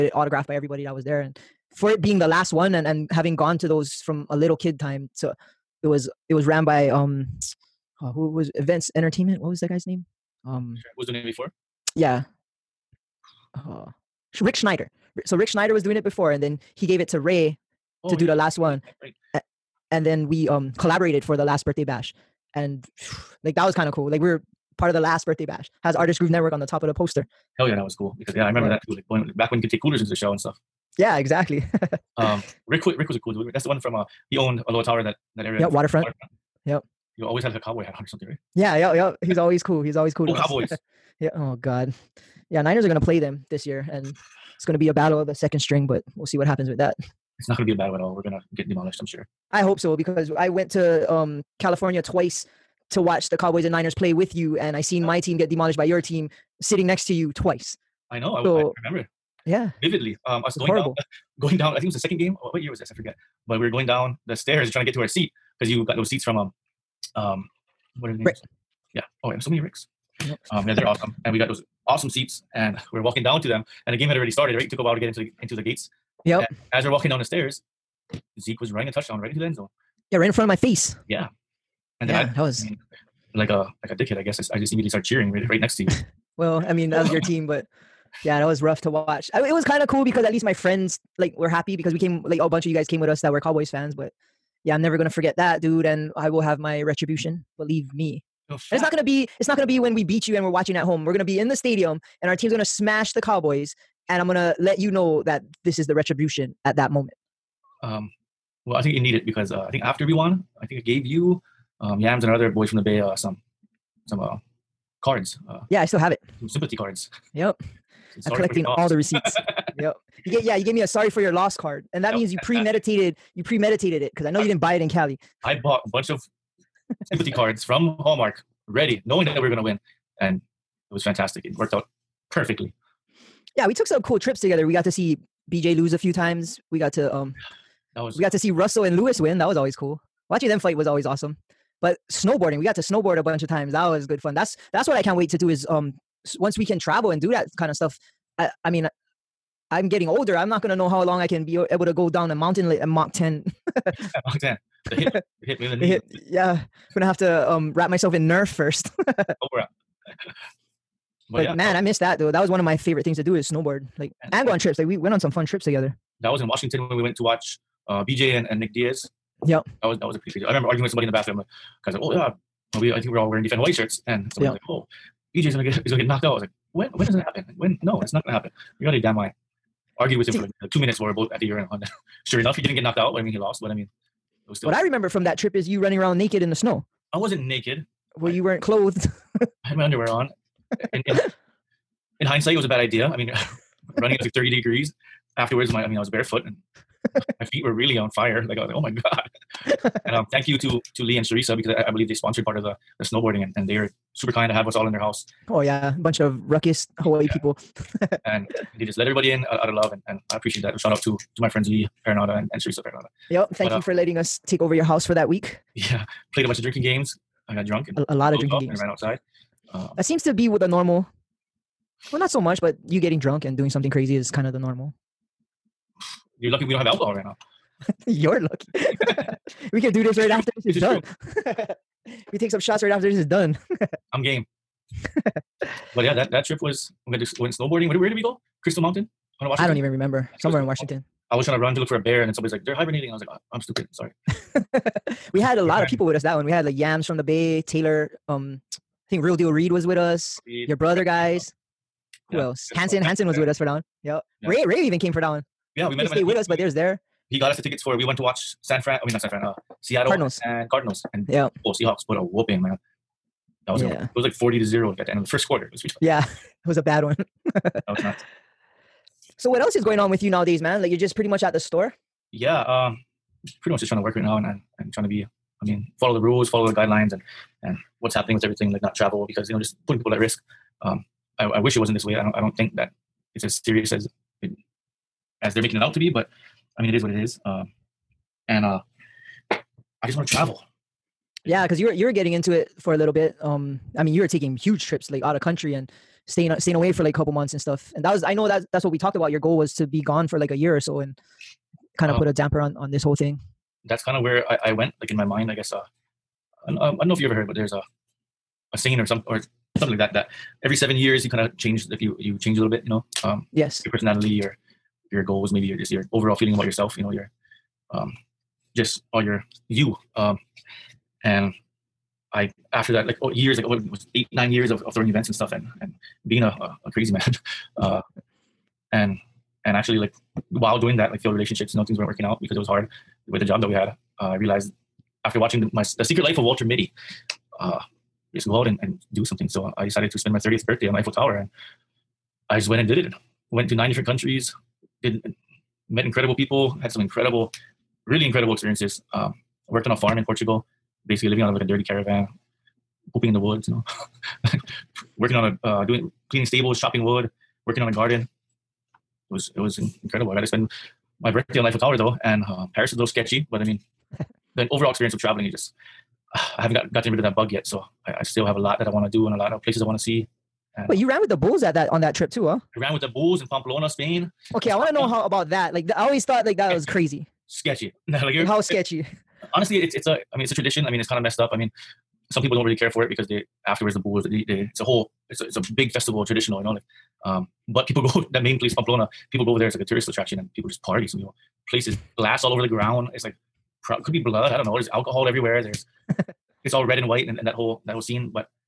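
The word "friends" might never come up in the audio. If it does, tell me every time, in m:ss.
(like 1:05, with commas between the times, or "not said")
1:30, 3:31.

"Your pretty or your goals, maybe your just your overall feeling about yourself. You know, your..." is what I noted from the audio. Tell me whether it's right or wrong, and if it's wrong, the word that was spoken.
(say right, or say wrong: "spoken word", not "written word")
wrong: "personality", not "pretty".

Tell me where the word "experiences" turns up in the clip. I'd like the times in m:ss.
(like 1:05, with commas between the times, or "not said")
5:48, 6:04.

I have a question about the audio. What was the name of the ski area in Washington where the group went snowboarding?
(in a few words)
Crystal Mountain.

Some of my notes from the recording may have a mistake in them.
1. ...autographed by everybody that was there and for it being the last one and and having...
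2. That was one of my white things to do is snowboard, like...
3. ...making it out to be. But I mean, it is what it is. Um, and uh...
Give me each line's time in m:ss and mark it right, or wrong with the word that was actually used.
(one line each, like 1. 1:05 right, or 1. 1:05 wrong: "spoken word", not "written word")
1. 0:00 right
2. 2:42 wrong: "favorite", not "white"
3. 4:45 right.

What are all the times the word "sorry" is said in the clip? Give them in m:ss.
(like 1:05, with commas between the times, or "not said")
2:00, 4:03.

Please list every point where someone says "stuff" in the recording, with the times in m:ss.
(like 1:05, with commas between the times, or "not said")
0:30, 2:27, 4:57, 5:25.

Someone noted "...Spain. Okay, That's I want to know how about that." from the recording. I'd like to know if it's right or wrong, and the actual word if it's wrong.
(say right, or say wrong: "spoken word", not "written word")
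right.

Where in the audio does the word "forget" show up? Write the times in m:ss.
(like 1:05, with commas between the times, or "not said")
1:02, 1:35.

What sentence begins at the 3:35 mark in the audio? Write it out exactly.
Yeah, played a bunch of drinking games.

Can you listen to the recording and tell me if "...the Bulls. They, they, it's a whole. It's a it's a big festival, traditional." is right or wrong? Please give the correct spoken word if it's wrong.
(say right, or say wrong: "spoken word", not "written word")
right.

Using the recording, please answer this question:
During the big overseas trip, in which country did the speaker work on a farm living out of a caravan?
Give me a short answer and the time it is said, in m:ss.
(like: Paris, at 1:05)
Portugal, at 5:50.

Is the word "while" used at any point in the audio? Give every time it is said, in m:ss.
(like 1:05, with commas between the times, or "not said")
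1:14, 3:00, 5:30.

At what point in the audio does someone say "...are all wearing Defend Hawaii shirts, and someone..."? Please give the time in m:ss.
2:53.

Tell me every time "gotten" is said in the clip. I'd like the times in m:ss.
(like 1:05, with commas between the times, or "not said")
6:06.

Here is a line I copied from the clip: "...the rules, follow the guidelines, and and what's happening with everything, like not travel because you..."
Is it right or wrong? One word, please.
right.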